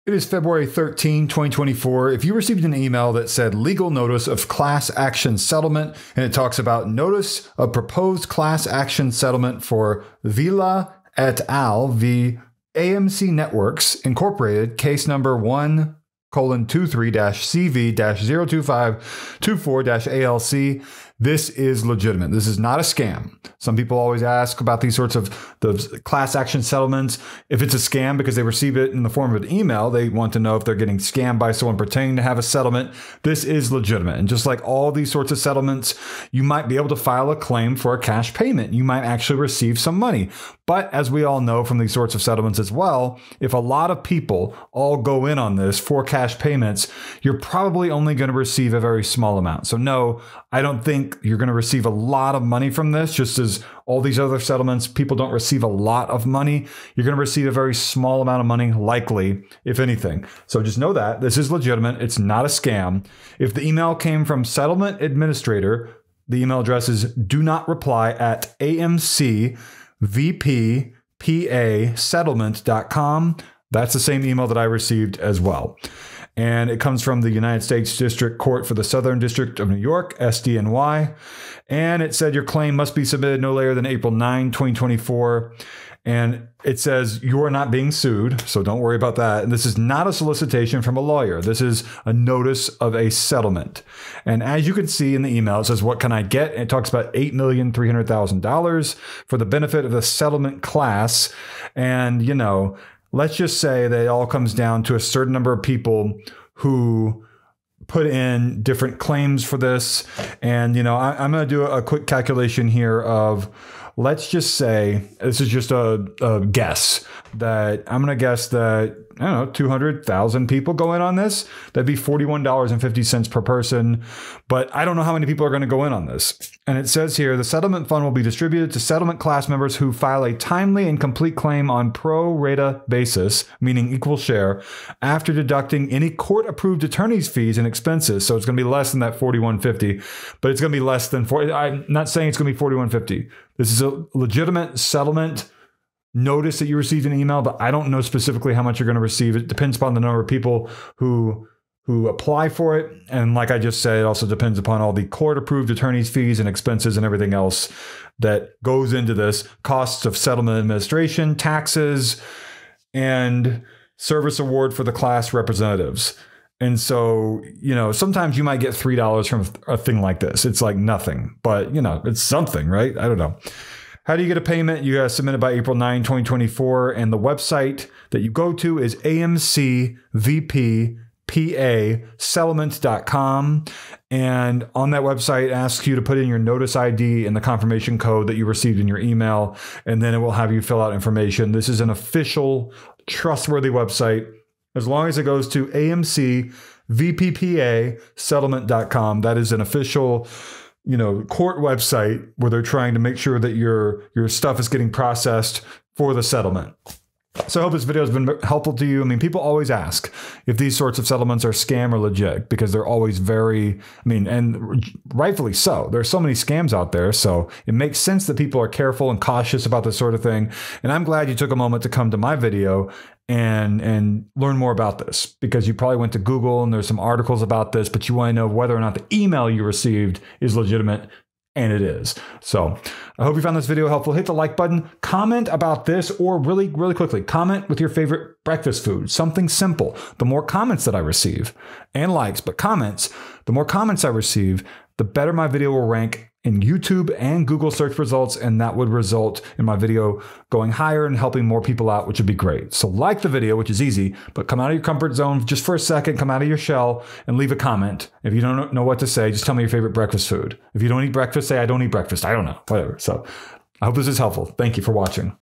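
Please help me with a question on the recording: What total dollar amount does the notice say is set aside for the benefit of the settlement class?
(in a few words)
$8,300,000.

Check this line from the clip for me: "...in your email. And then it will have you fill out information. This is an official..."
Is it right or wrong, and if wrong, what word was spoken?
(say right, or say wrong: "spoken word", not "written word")
right.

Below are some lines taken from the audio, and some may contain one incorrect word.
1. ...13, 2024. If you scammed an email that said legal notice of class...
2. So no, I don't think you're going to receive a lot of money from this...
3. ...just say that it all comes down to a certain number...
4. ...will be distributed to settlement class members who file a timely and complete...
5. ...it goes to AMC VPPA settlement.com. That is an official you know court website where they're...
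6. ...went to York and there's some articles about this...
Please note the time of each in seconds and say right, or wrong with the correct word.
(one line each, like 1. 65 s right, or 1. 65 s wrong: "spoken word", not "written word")
1. 0 s wrong: "received", not "scammed"
2. 49 s right
3. 103 s right
4. 128 s right
5. 195 s right
6. 225 s wrong: "Google", not "York".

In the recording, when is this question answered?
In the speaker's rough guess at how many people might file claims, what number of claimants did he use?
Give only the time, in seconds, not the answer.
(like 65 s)
119 s.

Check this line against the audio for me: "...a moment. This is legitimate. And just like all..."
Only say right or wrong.
wrong.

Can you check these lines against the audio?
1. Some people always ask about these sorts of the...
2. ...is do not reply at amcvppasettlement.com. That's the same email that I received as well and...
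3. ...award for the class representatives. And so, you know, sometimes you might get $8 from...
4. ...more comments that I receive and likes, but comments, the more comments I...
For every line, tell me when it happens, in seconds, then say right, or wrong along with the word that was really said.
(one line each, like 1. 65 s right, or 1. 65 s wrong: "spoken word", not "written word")
1. 23 s right
2. 66 s right
3. 164 s wrong: "3", not "8"
4. 240 s right.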